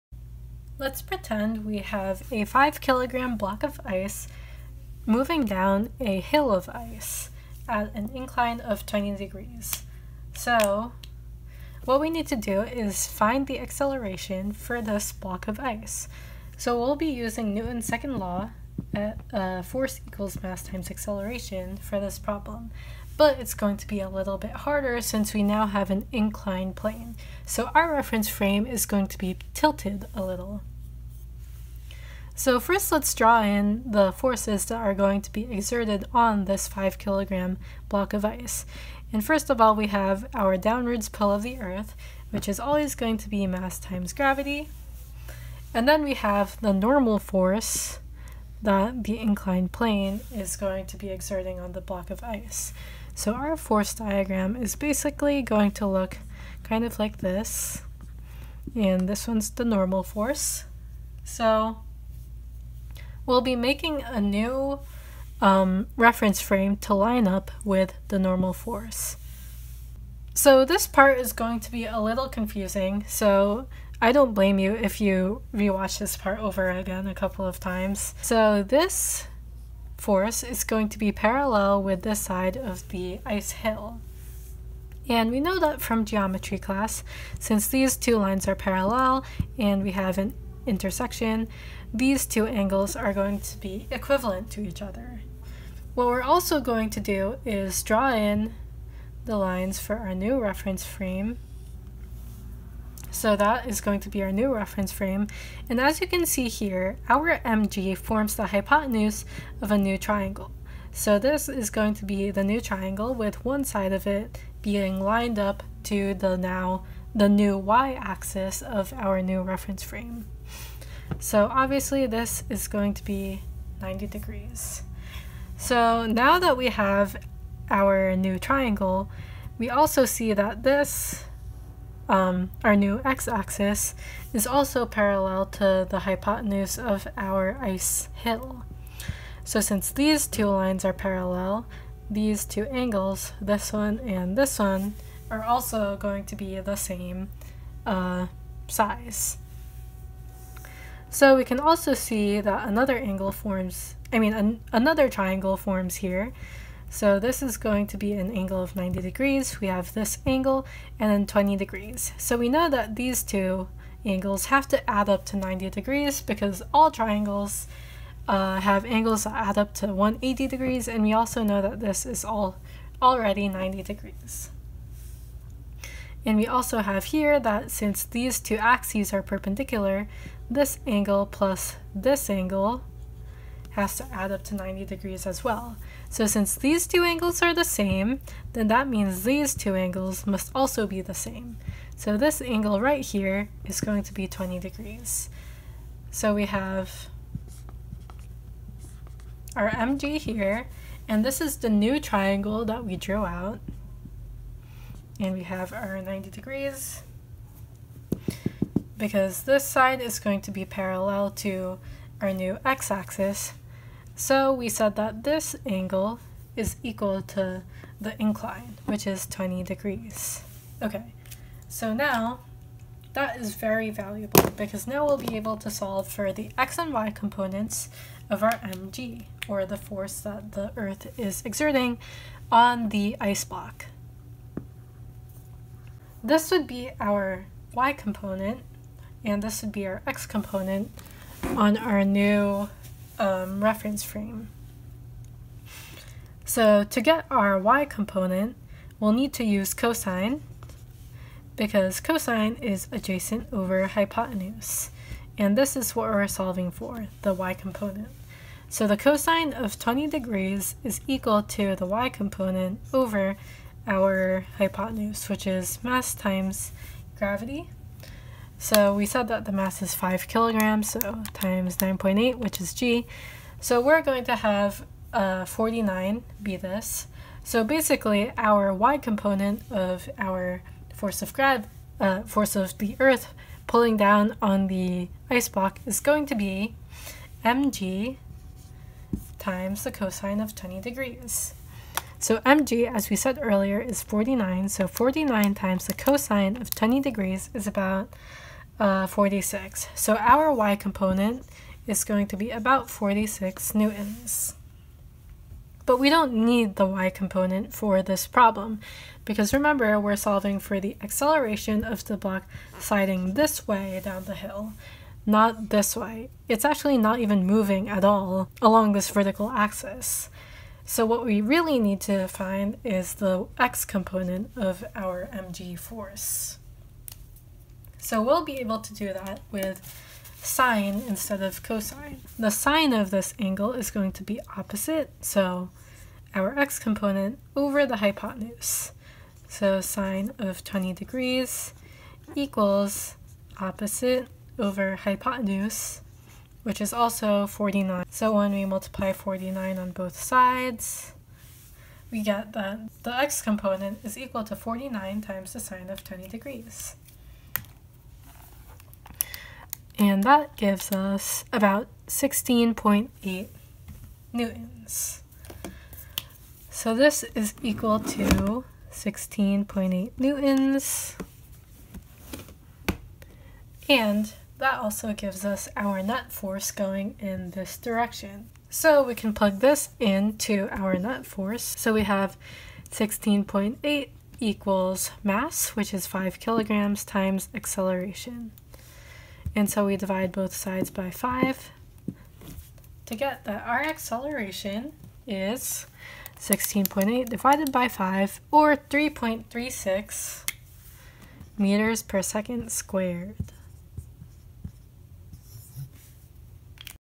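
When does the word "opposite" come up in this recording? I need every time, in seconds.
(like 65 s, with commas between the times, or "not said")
334 s, 343 s.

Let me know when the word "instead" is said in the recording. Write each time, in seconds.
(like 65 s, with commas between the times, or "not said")
331 s.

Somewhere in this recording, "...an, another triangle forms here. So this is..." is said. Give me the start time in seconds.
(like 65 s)
154 s.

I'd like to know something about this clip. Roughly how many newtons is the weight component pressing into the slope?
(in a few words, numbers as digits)
46 newtons.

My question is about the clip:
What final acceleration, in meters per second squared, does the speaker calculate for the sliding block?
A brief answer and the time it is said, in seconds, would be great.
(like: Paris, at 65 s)
3.36, at 398 s.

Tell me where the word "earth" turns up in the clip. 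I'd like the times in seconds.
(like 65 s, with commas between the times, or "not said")
41 s, 230 s, 282 s.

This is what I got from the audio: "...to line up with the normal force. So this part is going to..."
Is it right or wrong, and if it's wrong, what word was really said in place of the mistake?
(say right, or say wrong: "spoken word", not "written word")
right.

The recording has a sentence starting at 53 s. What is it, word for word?
So our force diagram is basically going to look kind of like this.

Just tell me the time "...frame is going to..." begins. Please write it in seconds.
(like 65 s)
28 s.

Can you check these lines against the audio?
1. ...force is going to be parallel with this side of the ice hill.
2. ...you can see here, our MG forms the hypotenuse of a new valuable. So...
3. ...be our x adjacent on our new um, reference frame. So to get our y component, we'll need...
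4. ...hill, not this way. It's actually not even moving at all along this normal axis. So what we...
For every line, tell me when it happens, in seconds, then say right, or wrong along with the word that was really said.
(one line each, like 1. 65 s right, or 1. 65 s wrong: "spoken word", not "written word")
1. 79 s right
2. 105 s wrong: "triangle", not "valuable"
3. 239 s wrong: "component", not "adjacent"
4. 314 s wrong: "vertical", not "normal".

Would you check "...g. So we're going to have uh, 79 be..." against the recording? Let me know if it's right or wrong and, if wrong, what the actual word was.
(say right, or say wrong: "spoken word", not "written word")
wrong: "49", not "79".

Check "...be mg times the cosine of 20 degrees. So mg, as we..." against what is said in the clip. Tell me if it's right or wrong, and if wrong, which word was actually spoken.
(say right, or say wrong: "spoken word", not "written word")
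right.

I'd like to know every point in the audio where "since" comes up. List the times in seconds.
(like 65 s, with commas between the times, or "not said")
25 s, 87 s, 139 s, 177 s, 186 s.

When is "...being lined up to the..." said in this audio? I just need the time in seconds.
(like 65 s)
114 s.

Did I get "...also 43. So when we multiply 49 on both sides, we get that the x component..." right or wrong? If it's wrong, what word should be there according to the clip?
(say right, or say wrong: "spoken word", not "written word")
wrong: "49", not "43".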